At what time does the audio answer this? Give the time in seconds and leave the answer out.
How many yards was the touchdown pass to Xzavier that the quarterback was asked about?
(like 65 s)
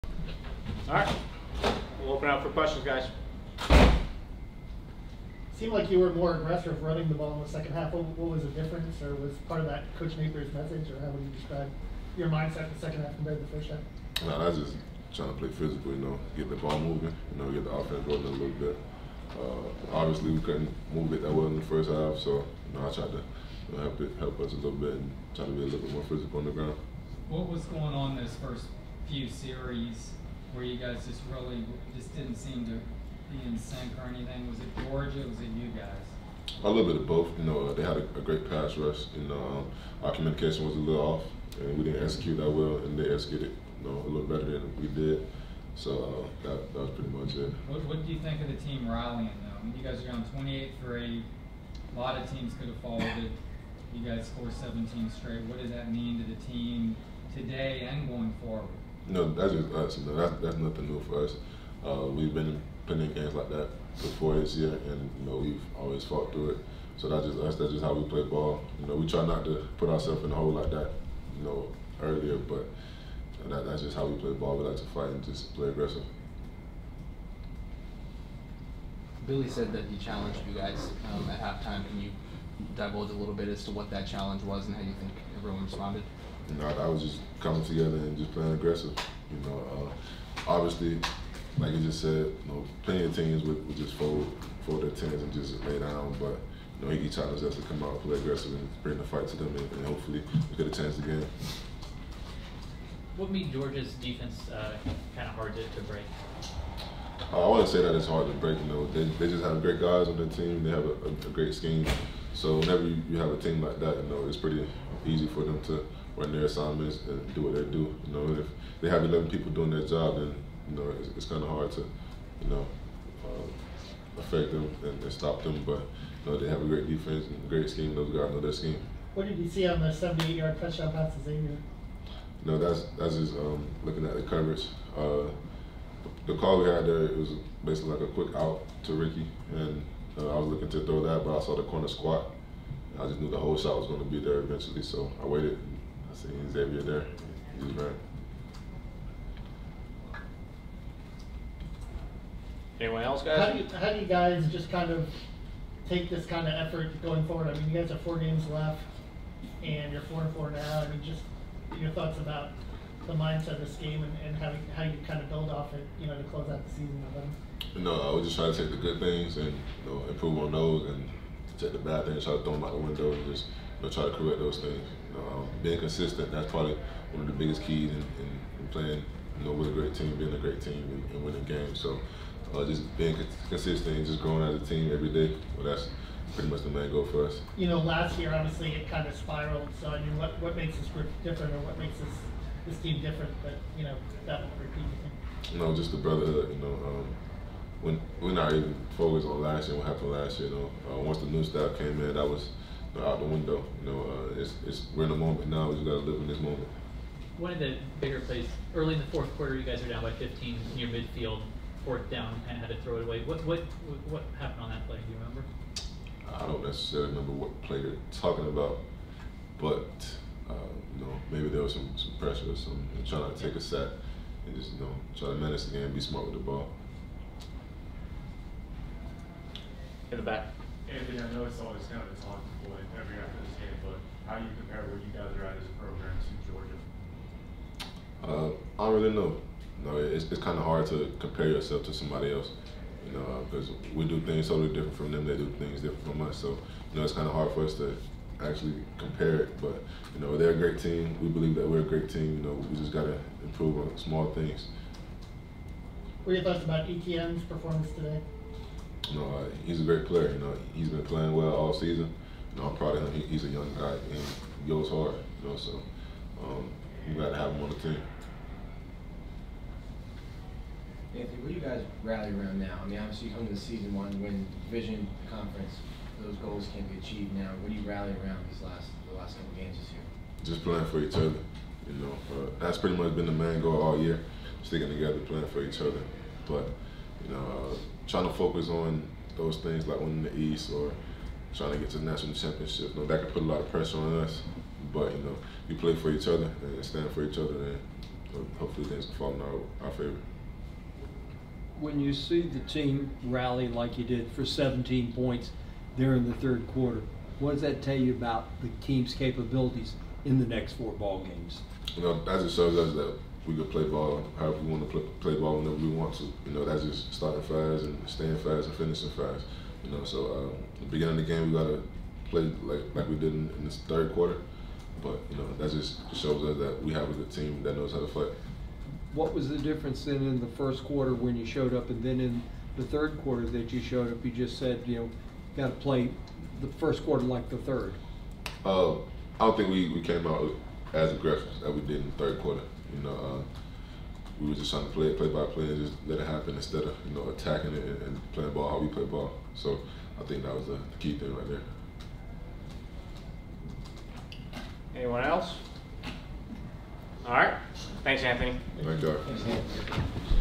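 129 s.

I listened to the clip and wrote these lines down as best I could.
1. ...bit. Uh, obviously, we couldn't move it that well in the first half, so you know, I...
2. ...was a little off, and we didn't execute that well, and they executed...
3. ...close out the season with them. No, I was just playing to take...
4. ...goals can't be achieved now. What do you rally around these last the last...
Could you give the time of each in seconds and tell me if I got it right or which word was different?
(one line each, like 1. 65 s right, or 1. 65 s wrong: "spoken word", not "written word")
1. 18 s right
2. 40 s right
3. 166 s wrong: "trying", not "playing"
4. 276 s right.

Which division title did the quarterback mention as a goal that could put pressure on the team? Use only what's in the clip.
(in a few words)
The East.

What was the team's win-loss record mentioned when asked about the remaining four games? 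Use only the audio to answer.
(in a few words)
4-4.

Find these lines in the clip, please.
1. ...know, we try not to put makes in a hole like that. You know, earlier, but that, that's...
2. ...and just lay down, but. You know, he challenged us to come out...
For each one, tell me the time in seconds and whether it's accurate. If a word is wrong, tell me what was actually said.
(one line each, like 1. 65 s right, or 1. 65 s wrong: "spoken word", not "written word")
1. 68 s wrong: "ourselves", not "makes"
2. 95 s right.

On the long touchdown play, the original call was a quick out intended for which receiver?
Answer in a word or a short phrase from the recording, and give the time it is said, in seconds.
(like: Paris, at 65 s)
Ricky, at 138 s.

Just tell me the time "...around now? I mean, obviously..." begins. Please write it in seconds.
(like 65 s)
272 s.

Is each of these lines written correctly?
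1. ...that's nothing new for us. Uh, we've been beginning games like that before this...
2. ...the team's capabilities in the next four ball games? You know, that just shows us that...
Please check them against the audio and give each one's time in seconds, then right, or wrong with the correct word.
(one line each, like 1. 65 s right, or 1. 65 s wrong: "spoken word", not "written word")
1. 60 s wrong: "putting", not "beginning"
2. 308 s right.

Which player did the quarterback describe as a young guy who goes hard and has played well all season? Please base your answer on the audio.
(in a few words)
Etienne.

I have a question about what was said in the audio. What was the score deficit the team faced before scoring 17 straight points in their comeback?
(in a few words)
28-3.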